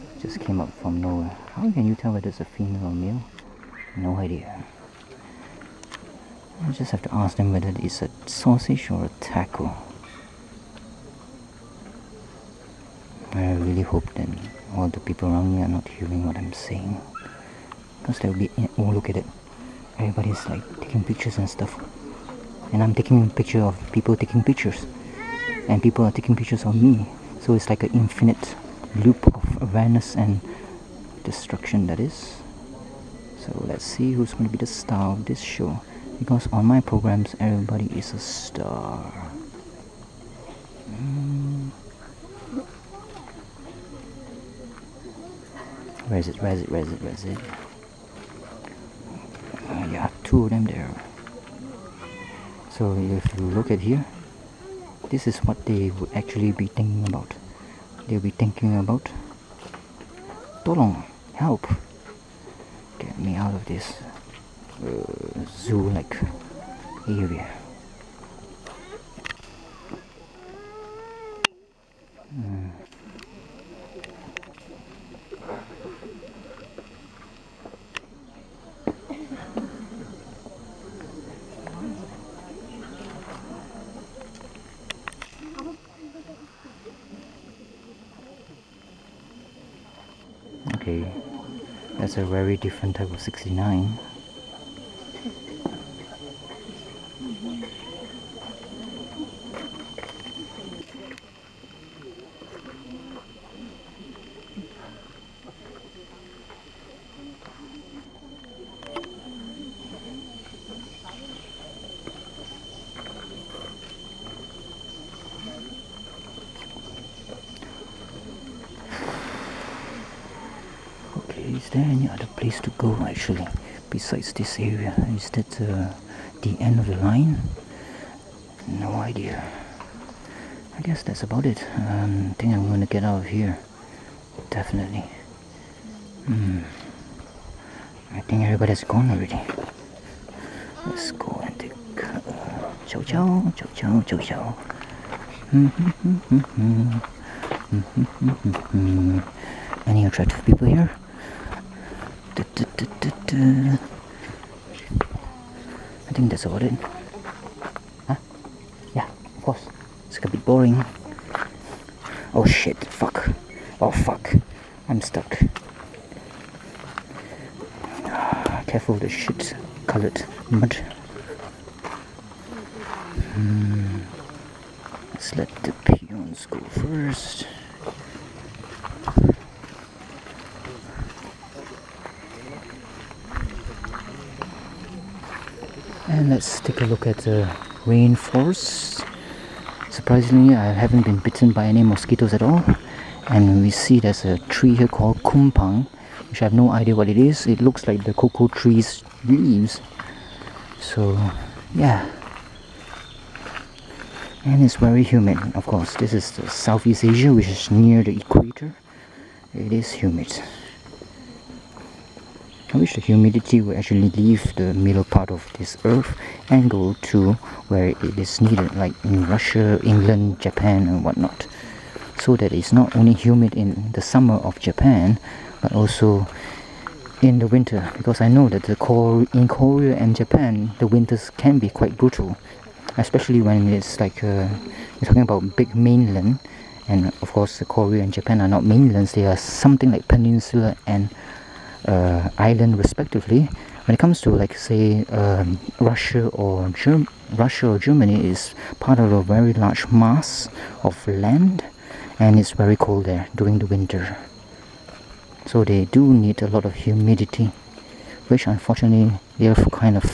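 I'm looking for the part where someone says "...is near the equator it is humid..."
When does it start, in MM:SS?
03:27.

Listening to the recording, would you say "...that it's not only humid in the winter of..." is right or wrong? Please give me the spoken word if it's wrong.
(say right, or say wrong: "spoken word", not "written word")
wrong: "summer", not "winter".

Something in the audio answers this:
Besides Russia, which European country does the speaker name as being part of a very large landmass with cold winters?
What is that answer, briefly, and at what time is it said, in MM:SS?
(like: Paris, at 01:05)
Germany, at 04:07.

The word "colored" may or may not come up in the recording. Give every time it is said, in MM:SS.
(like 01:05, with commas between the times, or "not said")
02:49.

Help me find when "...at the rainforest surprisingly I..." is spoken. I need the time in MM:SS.
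03:07.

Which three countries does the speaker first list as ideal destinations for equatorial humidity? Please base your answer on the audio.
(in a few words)
Russia, England, Japan.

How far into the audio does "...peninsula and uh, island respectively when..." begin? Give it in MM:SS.
04:00.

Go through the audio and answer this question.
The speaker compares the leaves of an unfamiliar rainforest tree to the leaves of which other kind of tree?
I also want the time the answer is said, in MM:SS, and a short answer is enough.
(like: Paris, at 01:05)
cocoa tree, at 03:18.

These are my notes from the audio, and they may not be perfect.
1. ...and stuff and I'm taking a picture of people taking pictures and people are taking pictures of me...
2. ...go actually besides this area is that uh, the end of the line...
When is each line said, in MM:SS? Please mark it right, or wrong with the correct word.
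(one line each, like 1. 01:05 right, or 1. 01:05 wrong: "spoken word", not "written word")
1. 00:21 right
2. 02:02 right.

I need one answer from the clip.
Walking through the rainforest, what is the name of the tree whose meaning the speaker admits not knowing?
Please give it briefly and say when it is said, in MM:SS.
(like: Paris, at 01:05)
kumpang, at 03:15.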